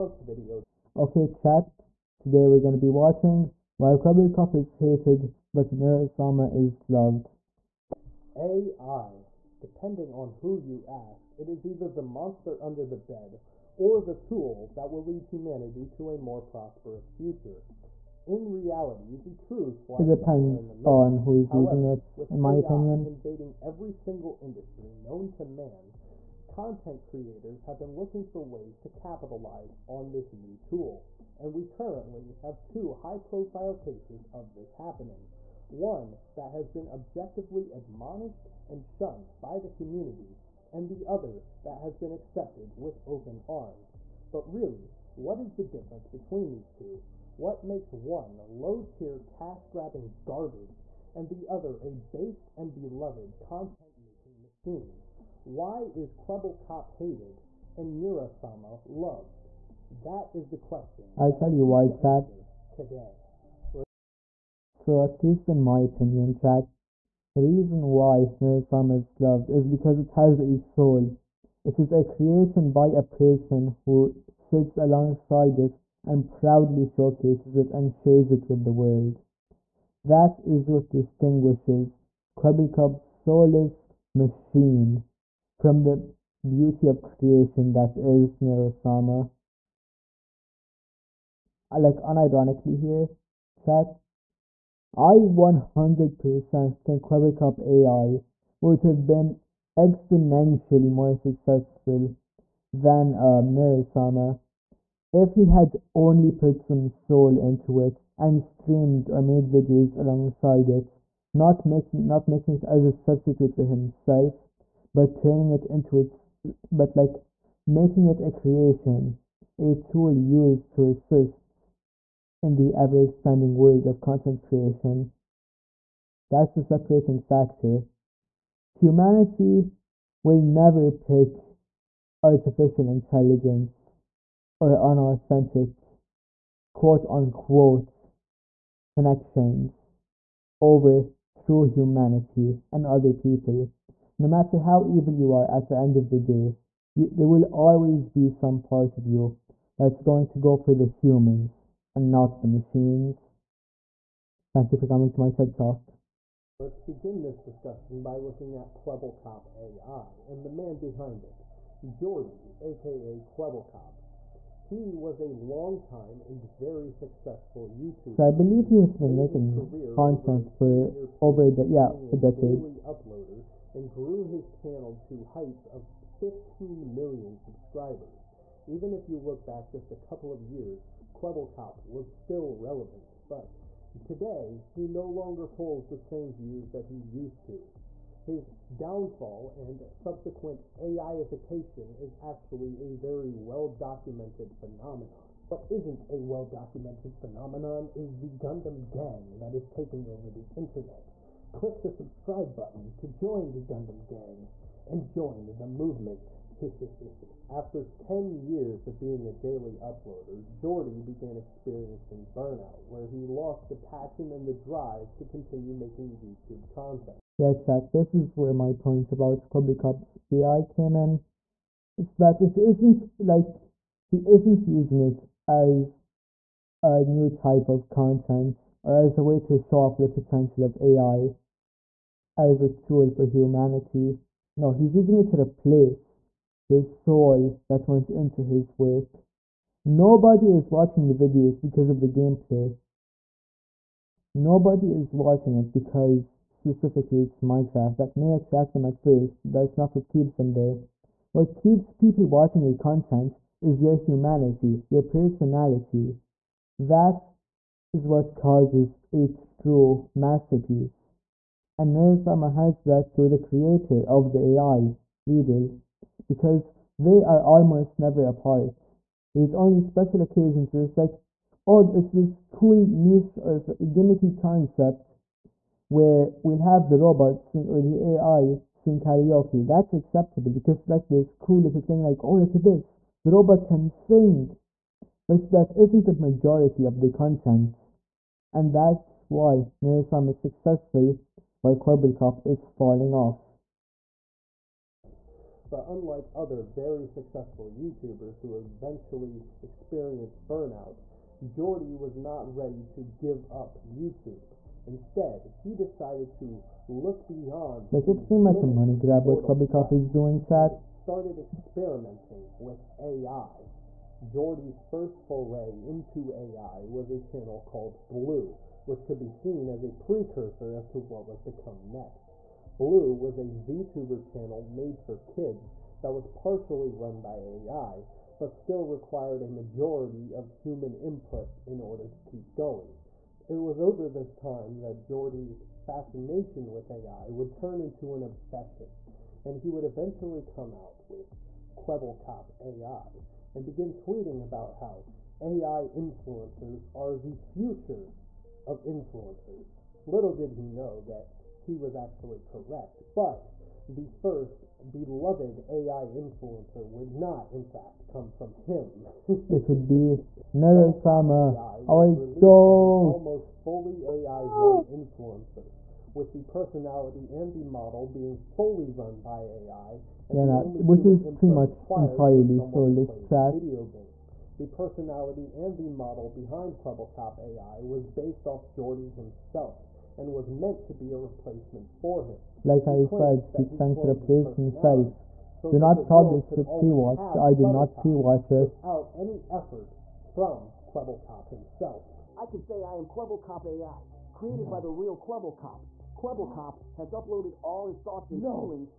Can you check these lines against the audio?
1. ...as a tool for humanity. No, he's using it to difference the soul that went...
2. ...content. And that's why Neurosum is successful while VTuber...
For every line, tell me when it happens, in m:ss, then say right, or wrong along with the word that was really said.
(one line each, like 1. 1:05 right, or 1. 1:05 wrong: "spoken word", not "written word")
1. 3:52 wrong: "replace", not "difference"
2. 4:47 wrong: "Kwebbelkop", not "VTuber".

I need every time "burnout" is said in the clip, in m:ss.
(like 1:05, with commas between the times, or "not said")
3:32, 5:00.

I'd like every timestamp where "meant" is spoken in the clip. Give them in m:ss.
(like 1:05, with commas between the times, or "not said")
6:20.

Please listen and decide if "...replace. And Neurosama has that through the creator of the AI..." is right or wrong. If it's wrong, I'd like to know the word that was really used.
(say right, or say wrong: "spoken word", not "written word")
wrong: "masterpiece", not "replace".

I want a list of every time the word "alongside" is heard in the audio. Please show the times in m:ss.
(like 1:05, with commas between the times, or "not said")
1:14, 1:49.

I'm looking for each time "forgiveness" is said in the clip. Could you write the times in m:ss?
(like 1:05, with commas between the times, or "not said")
not said.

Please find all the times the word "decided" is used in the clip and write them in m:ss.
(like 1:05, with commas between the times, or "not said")
5:05.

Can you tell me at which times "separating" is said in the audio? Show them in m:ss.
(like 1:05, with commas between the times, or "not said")
2:06.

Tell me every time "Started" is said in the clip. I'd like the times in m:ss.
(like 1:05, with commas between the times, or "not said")
5:10.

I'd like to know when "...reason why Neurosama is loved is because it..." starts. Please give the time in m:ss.
1:07.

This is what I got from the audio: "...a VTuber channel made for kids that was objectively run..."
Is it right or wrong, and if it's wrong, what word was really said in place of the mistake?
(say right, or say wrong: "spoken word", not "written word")
wrong: "partially", not "objectively".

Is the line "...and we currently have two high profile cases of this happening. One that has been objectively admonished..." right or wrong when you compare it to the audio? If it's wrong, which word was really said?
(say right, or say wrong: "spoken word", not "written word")
right.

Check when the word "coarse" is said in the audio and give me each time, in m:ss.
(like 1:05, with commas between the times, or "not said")
not said.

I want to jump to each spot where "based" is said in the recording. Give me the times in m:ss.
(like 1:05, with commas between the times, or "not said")
0:52, 6:18.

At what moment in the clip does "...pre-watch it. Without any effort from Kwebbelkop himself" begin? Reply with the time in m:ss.
6:27.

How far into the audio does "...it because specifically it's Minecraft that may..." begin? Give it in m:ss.
4:05.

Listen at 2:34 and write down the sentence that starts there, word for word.
Thank you for coming to my TED Talk.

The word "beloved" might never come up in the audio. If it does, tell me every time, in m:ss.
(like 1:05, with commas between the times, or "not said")
0:52, 5:54.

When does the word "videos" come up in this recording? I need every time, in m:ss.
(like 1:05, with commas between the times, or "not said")
0:00, 1:49, 4:01, 6:13.